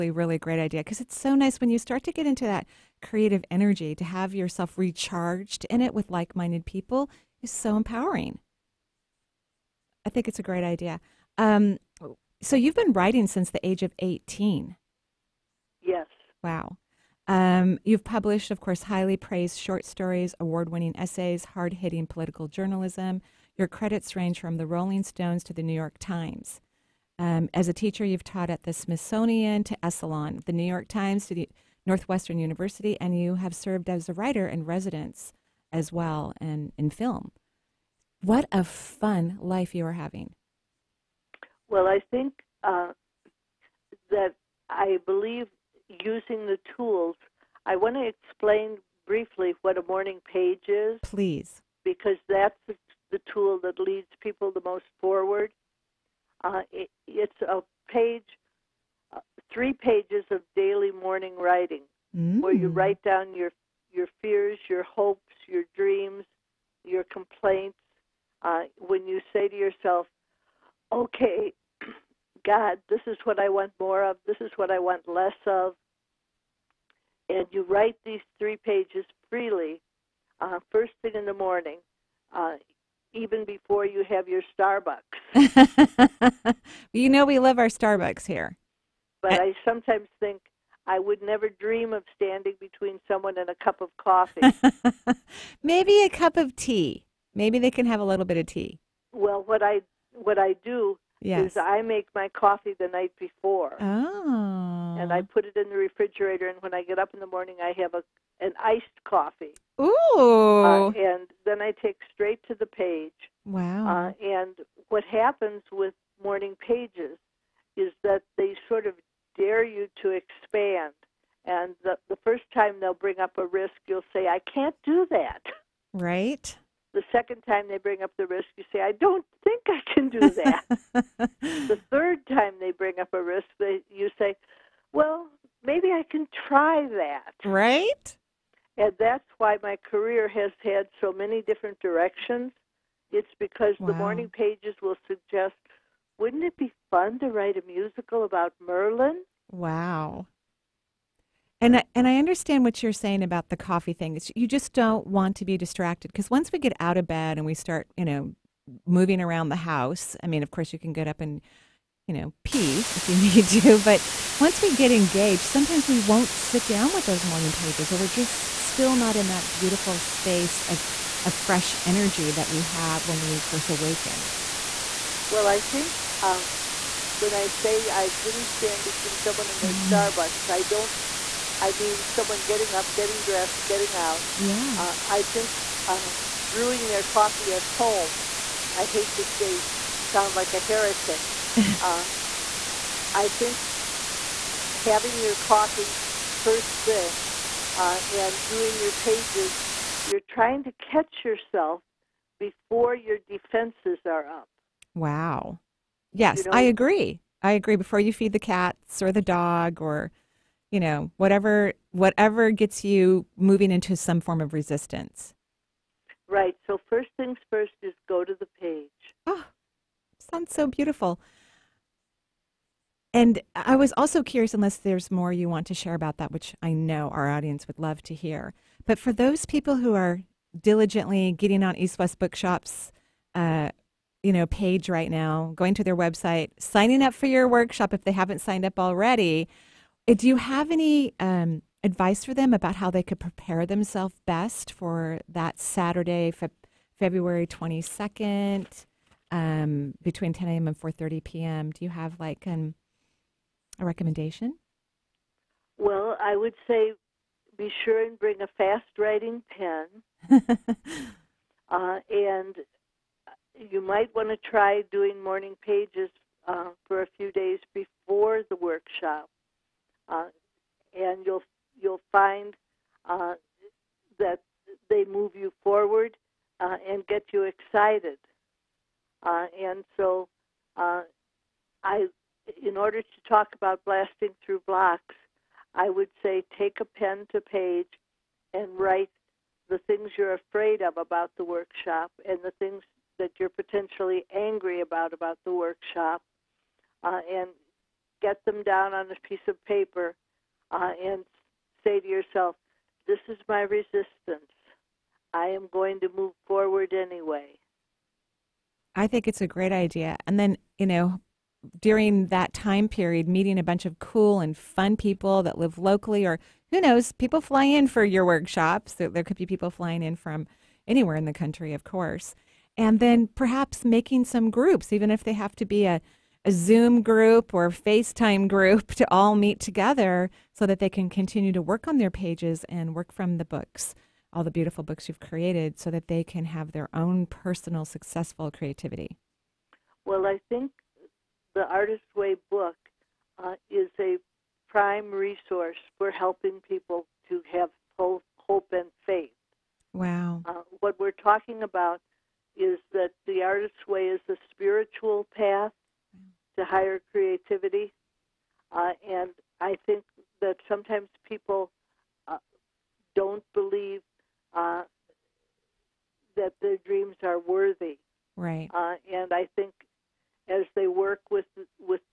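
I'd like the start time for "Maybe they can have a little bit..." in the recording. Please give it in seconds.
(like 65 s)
97 s.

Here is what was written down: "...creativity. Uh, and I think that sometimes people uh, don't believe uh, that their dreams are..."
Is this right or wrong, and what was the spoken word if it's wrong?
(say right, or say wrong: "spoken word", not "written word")
right.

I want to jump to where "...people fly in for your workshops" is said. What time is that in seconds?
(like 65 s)
317 s.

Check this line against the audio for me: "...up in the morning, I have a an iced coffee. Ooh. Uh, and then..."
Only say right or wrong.
right.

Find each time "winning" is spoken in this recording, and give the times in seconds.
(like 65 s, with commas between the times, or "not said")
20 s.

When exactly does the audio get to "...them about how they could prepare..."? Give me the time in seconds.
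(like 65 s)
242 s.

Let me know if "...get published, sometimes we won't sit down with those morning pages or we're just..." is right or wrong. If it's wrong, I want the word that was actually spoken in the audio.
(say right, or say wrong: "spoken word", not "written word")
wrong: "engaged", not "published".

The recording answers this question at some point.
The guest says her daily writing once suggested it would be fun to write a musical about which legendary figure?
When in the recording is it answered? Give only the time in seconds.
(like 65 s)
148 s.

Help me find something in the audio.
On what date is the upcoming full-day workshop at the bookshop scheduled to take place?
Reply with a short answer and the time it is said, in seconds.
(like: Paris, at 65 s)
February 22nd, at 246 s.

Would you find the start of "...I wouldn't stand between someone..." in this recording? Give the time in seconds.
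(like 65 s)
177 s.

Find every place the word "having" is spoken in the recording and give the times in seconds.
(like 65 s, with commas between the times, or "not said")
39 s, 194 s.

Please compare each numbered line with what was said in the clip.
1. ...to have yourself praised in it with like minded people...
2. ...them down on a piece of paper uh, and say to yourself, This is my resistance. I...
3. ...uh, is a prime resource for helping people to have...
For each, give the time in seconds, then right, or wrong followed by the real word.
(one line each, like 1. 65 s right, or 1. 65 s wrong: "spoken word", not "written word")
1. 3 s wrong: "recharged", not "praised"
2. 298 s right
3. 343 s right.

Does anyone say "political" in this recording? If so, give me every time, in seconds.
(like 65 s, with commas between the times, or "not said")
22 s.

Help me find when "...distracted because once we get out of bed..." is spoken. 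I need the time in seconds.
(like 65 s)
155 s.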